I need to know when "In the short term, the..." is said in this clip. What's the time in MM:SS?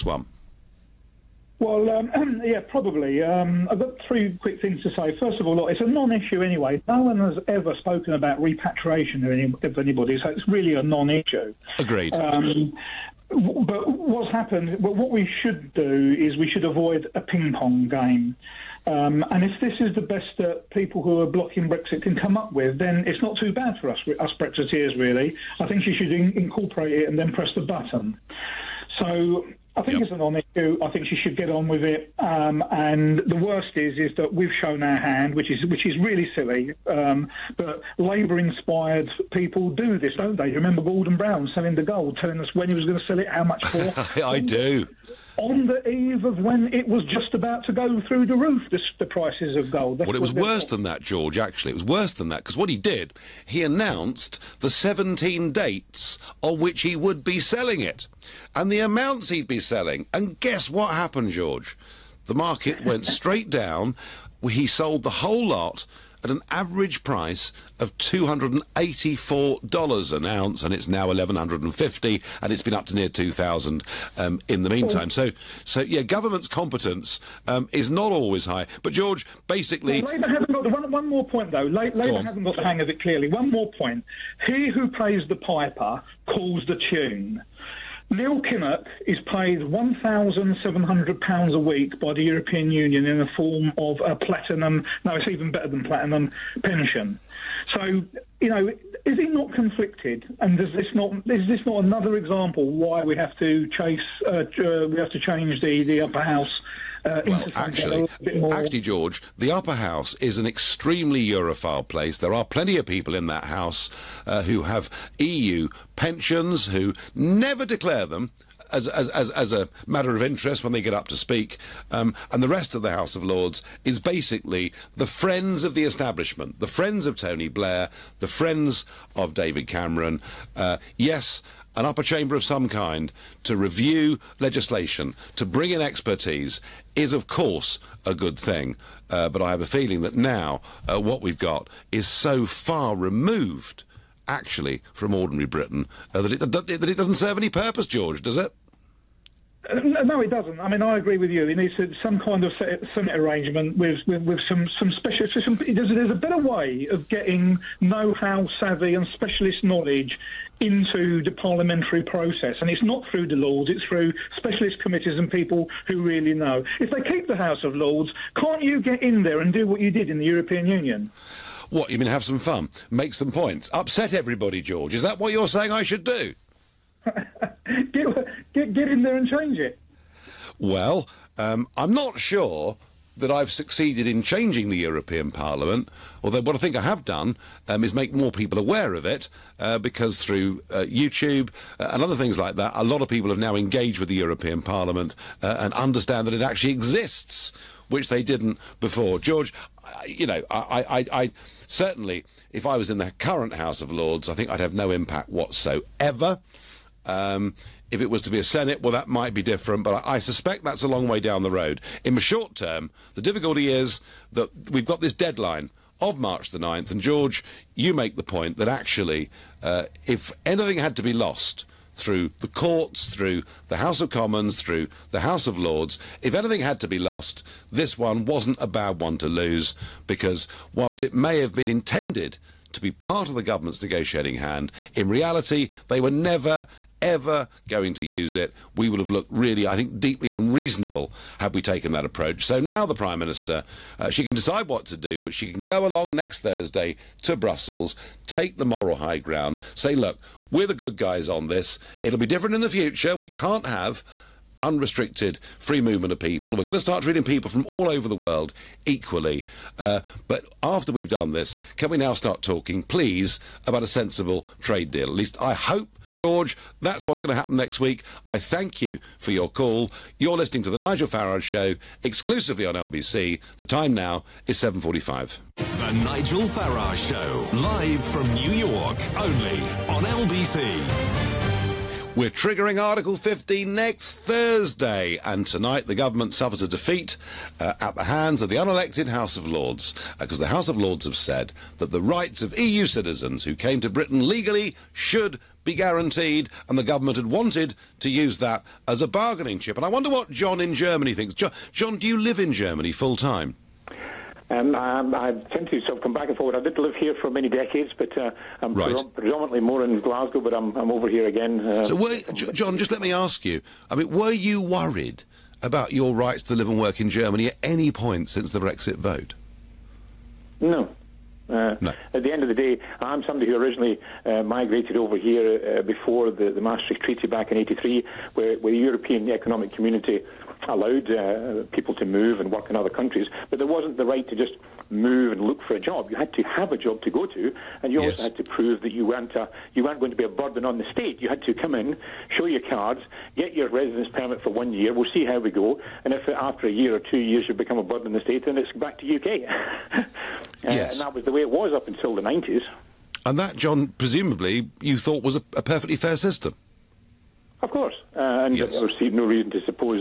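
03:32.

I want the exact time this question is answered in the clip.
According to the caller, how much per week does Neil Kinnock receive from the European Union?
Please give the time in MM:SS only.
01:29.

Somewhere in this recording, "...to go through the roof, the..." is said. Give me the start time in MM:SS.
00:47.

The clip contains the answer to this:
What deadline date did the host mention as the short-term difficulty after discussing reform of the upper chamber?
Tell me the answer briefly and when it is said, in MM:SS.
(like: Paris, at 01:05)
March 9th, at 03:36.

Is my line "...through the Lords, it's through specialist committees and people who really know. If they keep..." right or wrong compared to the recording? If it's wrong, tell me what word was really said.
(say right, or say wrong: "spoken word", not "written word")
right.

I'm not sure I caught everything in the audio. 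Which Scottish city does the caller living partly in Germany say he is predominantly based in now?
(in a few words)
Glasgow.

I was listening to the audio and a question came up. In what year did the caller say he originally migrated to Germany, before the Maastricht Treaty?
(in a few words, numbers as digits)
1983.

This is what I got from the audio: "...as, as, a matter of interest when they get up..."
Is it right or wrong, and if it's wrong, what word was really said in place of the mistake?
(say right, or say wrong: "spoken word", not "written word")
right.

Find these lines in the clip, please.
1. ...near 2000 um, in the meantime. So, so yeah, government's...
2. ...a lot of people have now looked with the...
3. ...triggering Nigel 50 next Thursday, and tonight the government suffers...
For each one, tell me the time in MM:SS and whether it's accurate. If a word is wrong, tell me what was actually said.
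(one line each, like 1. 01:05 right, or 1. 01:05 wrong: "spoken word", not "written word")
1. 01:12 right
2. 03:12 wrong: "engaged", not "looked"
3. 04:42 wrong: "Article", not "Nigel".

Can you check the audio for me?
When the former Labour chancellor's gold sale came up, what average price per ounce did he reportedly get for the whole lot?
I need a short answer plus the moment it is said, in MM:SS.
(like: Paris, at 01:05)
$284, at 01:07.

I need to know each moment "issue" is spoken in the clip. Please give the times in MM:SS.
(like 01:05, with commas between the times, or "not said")
00:05, 00:10, 00:30.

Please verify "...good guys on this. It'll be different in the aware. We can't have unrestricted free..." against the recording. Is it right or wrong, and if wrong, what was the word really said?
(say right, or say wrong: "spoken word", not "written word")
wrong: "future", not "aware".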